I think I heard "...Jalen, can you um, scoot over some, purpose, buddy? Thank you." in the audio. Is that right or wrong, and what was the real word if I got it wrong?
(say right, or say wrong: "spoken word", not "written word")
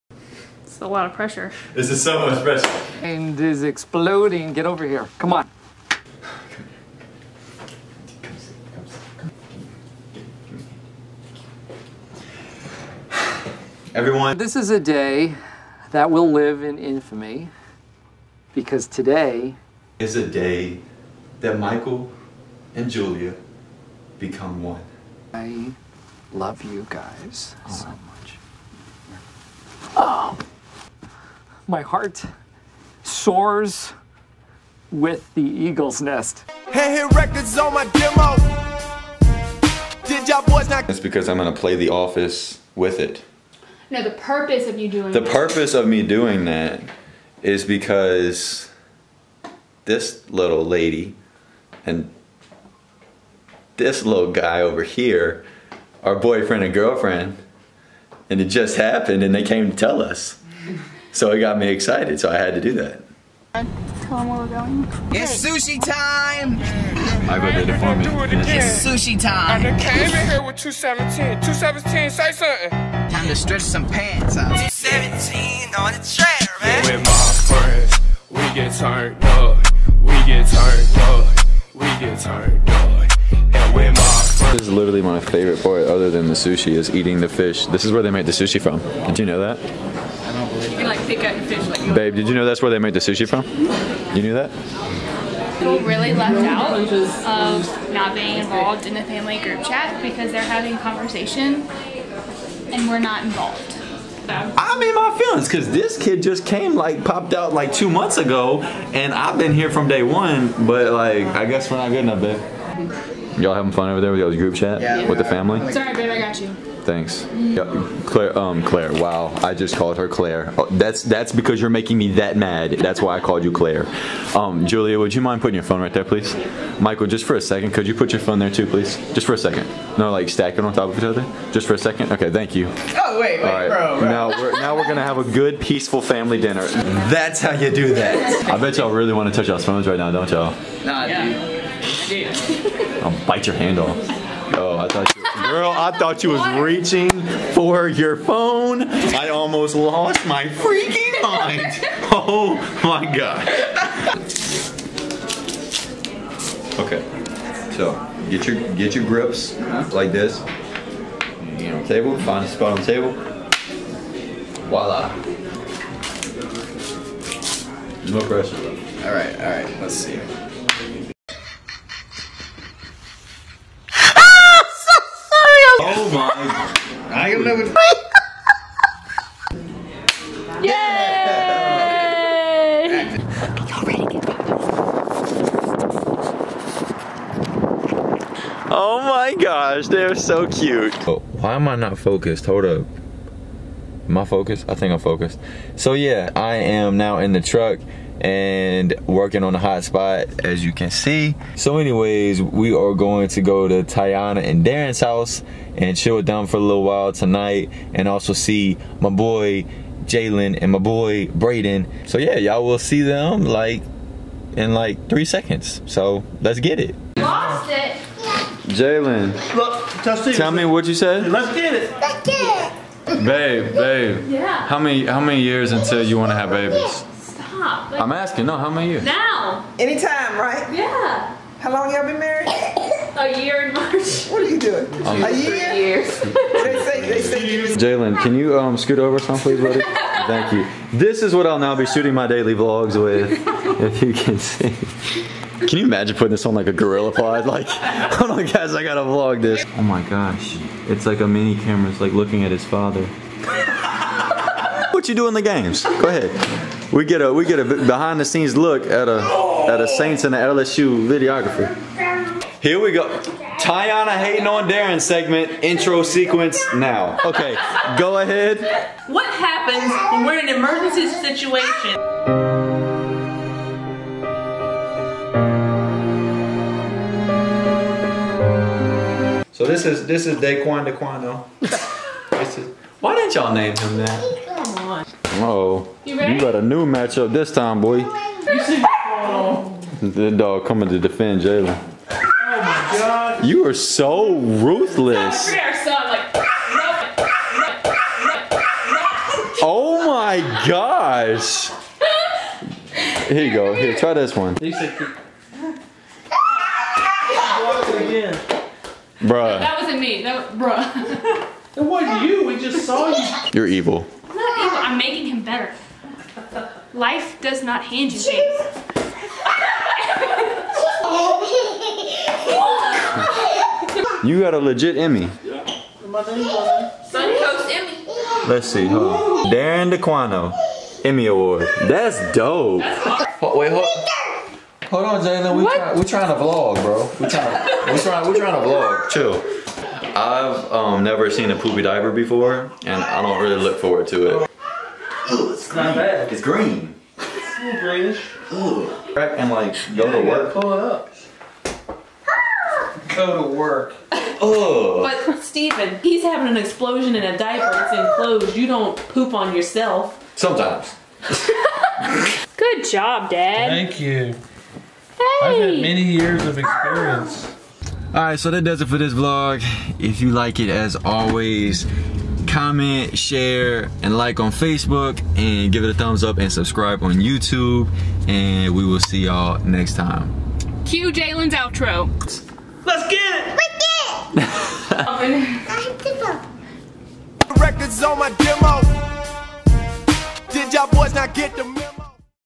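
wrong: "please", not "purpose".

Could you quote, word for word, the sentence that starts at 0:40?
It's because I'm gonna play The Office with it.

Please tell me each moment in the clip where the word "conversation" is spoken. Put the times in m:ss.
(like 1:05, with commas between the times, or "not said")
1:40.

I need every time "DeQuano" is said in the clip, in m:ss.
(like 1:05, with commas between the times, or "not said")
4:40, 5:29.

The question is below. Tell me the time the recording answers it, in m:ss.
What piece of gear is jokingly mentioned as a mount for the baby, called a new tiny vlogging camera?
4:06.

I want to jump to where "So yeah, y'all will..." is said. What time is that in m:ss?
3:32.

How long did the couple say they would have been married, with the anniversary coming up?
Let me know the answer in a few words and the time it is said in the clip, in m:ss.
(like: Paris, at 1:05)
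A year in March, at 3:52.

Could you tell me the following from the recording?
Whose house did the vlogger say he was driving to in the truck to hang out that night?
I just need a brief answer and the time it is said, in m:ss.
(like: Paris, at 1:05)
Tiana and Darren's, at 3:23.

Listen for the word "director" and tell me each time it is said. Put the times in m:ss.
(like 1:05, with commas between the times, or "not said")
not said.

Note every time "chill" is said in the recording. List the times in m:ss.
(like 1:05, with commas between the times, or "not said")
3:25, 5:39.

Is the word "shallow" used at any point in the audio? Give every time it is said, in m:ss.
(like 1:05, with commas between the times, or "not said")
not said.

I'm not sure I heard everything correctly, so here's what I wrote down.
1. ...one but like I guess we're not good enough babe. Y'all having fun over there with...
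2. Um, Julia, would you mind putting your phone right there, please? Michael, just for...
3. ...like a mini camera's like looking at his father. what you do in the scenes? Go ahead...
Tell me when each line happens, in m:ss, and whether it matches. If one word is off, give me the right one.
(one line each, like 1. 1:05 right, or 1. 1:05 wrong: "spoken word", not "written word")
1. 1:50 right
2. 2:04 right
3. 4:11 wrong: "games", not "scenes".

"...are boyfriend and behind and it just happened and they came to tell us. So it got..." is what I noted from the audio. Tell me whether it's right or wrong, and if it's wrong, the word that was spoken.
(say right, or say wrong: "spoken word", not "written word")
wrong: "girlfriend", not "behind".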